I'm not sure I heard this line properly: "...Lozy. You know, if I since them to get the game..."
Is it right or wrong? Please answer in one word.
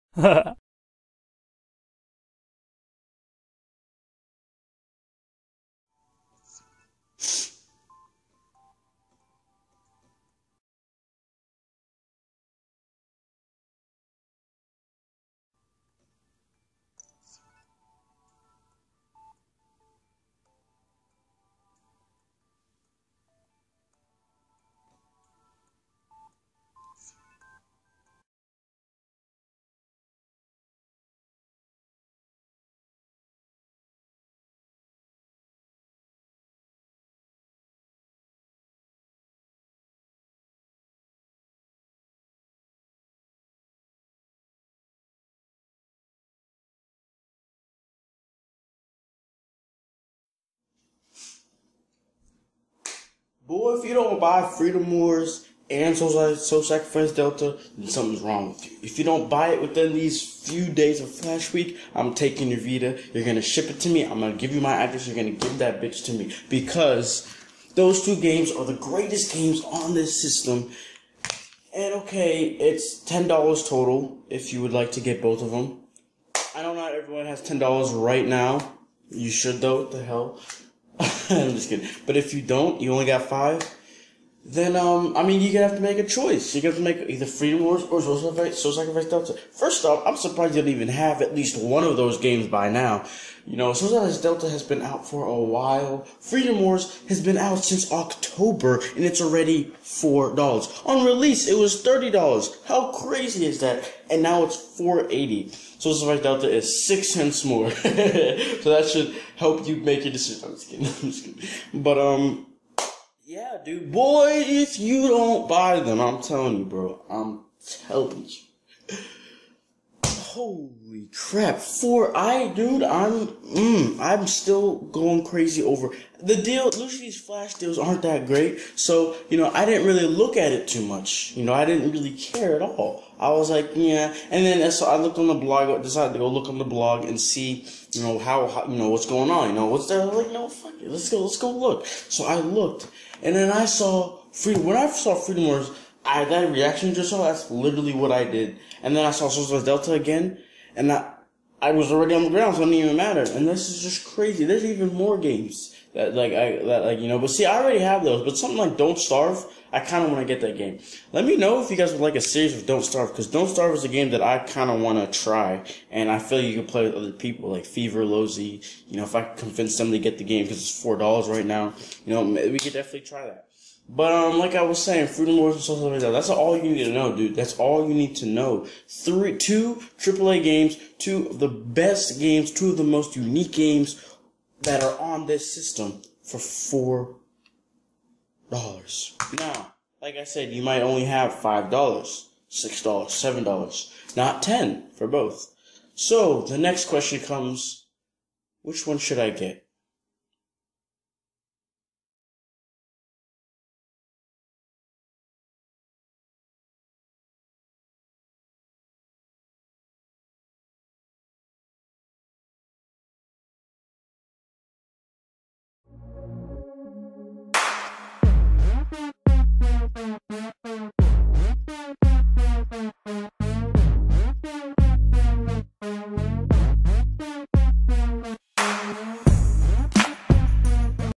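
wrong.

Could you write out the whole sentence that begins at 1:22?
But if you don't, you only got five then um, I mean, you have to make a choice.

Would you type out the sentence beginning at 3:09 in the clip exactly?
Now, like I said, you might only have five dollars, six dollars, seven dollars, not ten for both.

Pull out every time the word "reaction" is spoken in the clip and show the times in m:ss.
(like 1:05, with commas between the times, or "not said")
2:26.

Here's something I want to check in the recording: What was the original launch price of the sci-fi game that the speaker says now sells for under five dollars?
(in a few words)
$30.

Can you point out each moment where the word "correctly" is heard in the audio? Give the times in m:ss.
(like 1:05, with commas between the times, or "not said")
not said.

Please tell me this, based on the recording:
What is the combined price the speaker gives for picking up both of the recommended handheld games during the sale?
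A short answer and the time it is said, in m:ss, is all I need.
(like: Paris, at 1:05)
$10, at 1:12.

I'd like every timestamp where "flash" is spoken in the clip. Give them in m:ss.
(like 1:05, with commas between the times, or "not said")
1:01, 2:07.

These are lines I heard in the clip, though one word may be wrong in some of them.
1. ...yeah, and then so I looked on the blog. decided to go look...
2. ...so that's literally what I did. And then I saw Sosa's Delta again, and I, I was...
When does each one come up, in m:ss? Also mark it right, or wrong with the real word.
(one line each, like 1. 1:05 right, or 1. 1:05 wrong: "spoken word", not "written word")
1. 2:13 right
2. 2:27 right.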